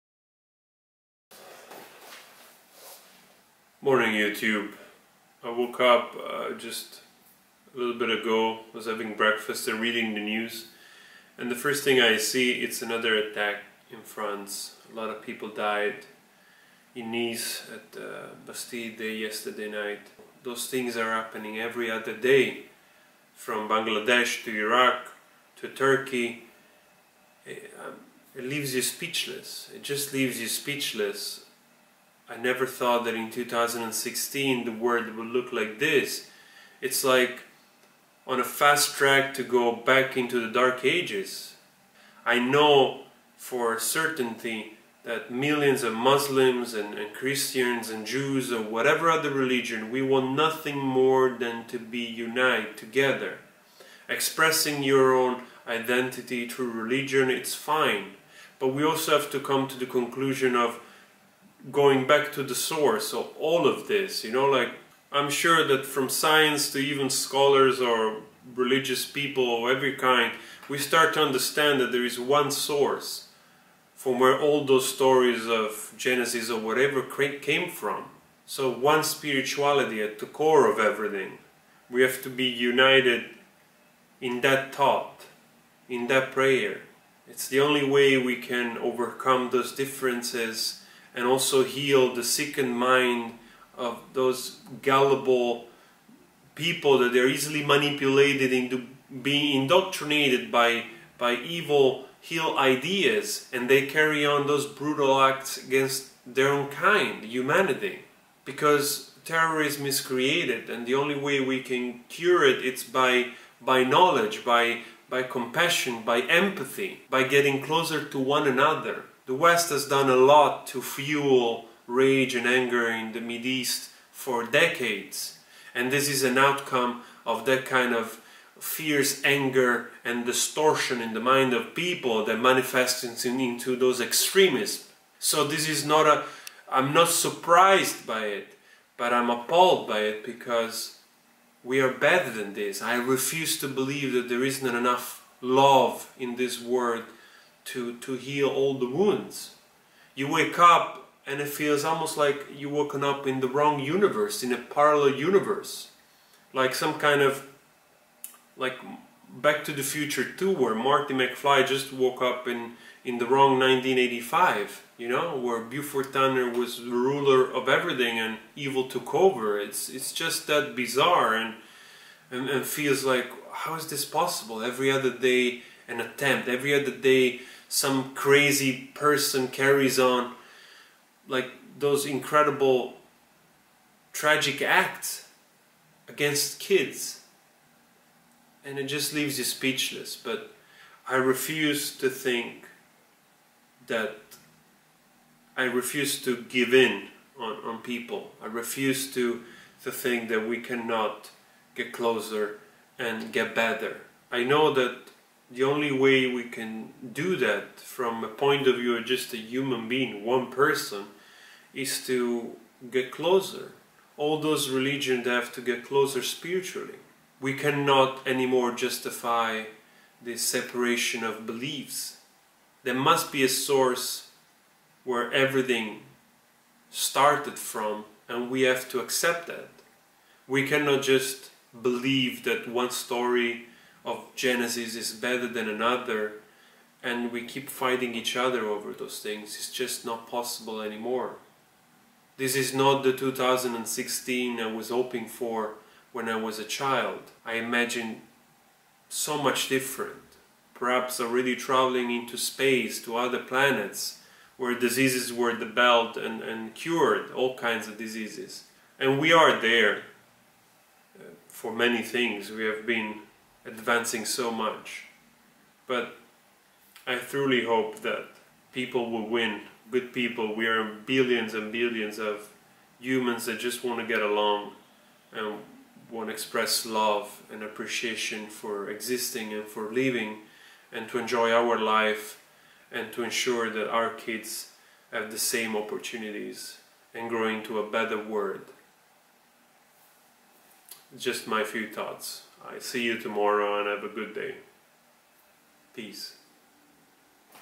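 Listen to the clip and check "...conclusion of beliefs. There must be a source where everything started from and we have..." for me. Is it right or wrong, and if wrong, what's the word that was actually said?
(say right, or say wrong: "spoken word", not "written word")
wrong: "separation", not "conclusion".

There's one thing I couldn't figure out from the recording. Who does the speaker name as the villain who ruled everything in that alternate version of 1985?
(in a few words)
Buford Tannen.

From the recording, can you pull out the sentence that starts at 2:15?
So this is not a, I'm not surprised by it, but I'm appalled by it because we are better than this.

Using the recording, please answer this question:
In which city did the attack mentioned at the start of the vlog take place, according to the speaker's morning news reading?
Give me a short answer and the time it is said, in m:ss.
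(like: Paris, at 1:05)
Nice, at 0:17.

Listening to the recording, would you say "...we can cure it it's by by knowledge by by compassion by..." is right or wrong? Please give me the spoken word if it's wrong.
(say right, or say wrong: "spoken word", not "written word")
right.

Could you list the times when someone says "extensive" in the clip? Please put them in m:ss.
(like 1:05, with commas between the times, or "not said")
not said.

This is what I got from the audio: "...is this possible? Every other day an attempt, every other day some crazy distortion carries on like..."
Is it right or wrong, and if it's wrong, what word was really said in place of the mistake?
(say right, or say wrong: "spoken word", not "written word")
wrong: "person", not "distortion".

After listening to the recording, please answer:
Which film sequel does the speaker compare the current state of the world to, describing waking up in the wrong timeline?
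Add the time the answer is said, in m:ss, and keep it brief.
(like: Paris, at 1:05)
Back to the Future 2, at 2:39.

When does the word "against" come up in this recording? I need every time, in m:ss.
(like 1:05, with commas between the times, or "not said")
1:45, 3:06.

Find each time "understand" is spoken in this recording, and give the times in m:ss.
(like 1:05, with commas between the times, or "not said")
1:11.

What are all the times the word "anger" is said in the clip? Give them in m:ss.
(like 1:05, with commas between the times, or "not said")
2:02, 2:09.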